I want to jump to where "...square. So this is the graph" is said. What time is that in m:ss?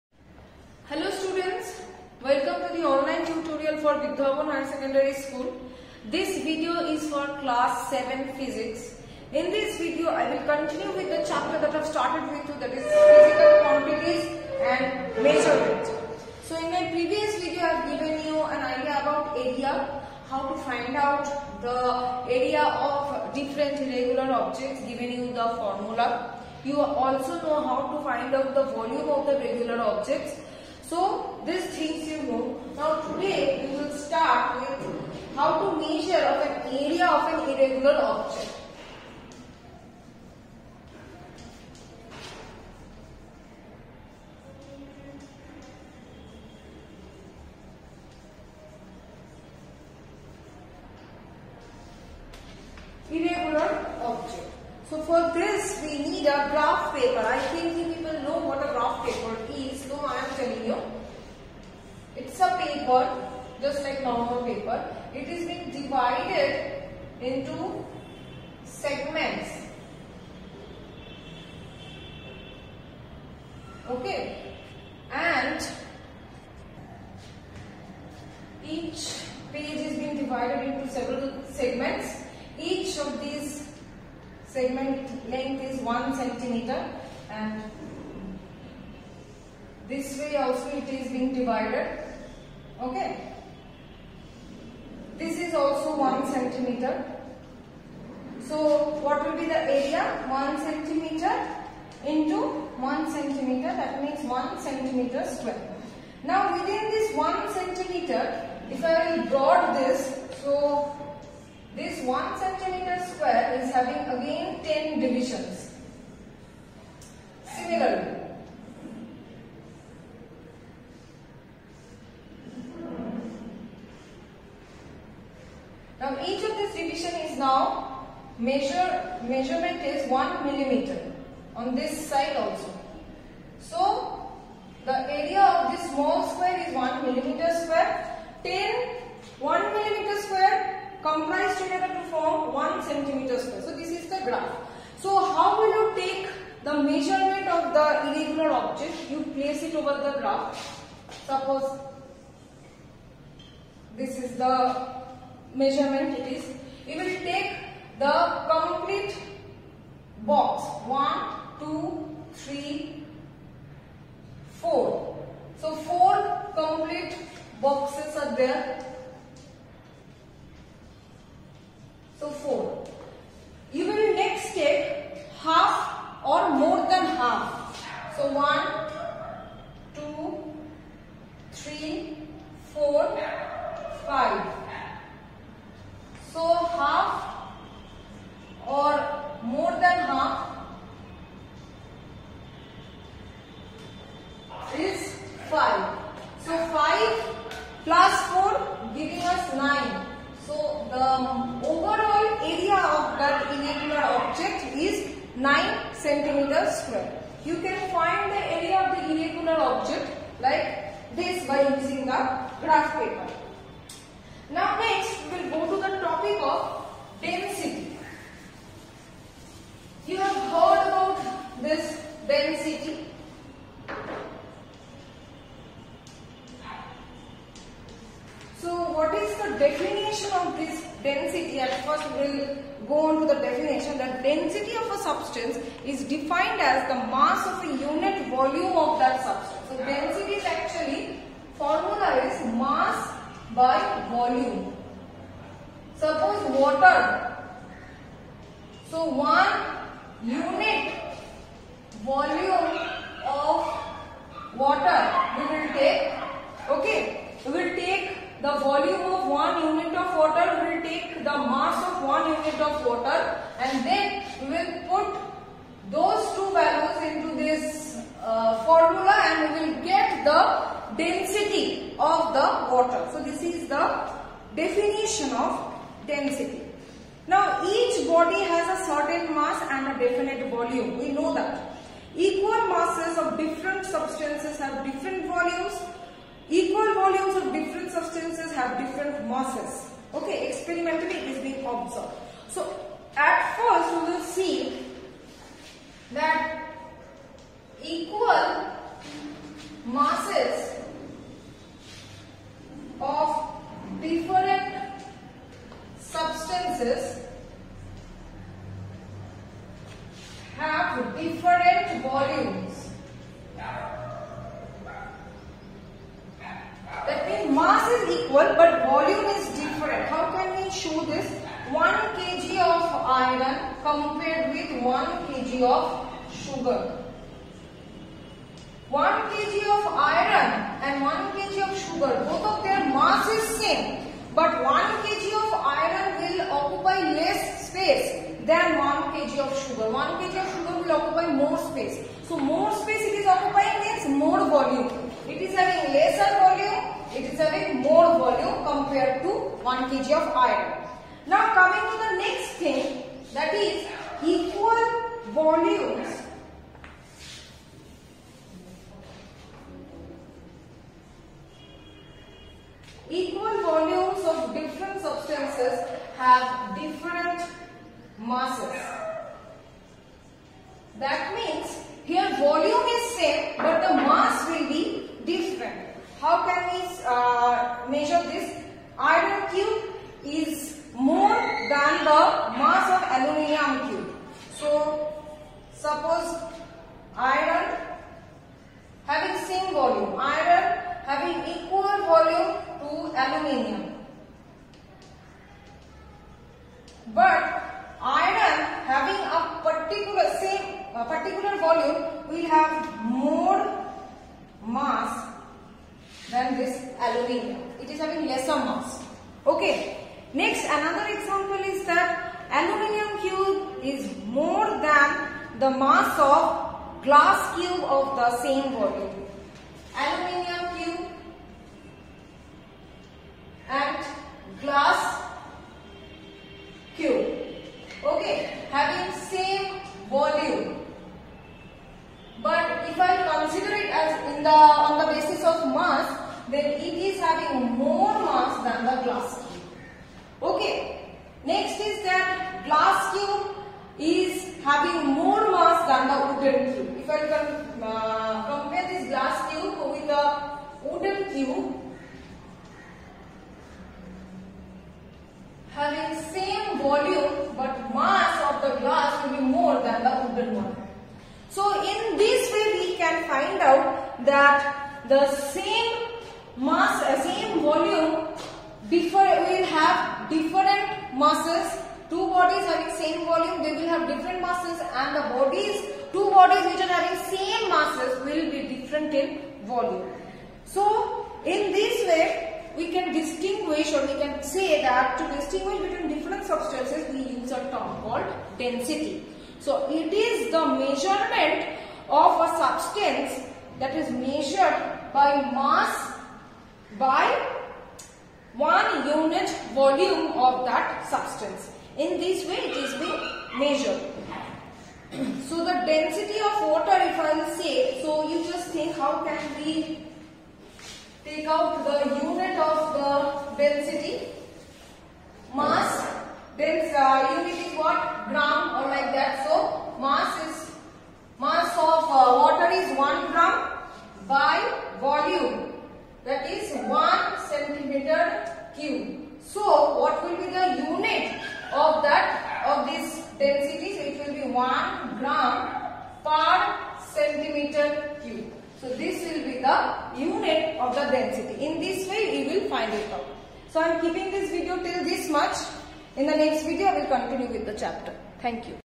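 2:23.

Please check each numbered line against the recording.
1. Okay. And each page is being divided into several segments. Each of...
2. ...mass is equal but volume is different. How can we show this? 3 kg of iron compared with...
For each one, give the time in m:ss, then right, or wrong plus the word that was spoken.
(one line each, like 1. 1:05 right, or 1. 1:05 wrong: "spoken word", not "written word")
1. 1:13 right
2. 5:17 wrong: "1", not "3".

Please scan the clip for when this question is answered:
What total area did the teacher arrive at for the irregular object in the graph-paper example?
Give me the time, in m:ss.
3:25.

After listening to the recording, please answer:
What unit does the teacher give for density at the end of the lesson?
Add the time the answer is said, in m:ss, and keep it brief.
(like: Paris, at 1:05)
Gram per centimeter cube, at 8:55.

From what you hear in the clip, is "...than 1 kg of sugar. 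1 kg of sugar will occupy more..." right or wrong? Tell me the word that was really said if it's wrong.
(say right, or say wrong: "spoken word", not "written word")
right.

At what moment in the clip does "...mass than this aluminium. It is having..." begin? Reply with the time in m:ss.
6:44.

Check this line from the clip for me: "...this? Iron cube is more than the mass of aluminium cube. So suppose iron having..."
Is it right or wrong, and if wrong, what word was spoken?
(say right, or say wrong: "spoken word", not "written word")
right.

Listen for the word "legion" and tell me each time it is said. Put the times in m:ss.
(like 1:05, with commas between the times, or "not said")
not said.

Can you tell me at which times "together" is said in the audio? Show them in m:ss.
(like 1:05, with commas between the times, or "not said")
2:21.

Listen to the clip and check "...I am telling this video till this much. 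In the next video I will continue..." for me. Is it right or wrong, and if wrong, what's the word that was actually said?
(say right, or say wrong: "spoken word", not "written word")
wrong: "keeping", not "telling".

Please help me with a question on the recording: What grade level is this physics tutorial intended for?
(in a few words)
Class 7.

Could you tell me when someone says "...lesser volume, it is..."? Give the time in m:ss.
5:45.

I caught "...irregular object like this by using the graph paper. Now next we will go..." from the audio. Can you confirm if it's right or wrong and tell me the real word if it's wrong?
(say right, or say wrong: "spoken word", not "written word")
right.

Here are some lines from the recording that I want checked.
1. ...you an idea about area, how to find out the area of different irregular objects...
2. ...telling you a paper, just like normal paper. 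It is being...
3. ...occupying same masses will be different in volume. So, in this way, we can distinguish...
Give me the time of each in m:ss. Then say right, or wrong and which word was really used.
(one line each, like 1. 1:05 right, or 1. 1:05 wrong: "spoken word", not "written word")
1. 0:18 right
2. 1:00 right
3. 7:56 wrong: "having", not "occupying".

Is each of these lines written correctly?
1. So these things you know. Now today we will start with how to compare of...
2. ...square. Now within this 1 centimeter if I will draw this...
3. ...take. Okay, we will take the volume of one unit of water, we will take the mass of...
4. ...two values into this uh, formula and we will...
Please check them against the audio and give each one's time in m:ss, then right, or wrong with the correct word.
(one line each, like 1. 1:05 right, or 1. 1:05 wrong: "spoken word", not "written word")
1. 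0:30 wrong: "measure", not "compare"
2. 1:45 right
3. 4:15 right
4. 4:26 right.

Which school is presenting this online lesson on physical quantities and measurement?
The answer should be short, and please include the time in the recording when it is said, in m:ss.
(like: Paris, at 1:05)
Bidya Bhaban High Secondary School, at 0:03.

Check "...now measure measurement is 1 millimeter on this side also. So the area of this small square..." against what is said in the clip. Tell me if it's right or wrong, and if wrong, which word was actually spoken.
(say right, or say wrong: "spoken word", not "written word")
right.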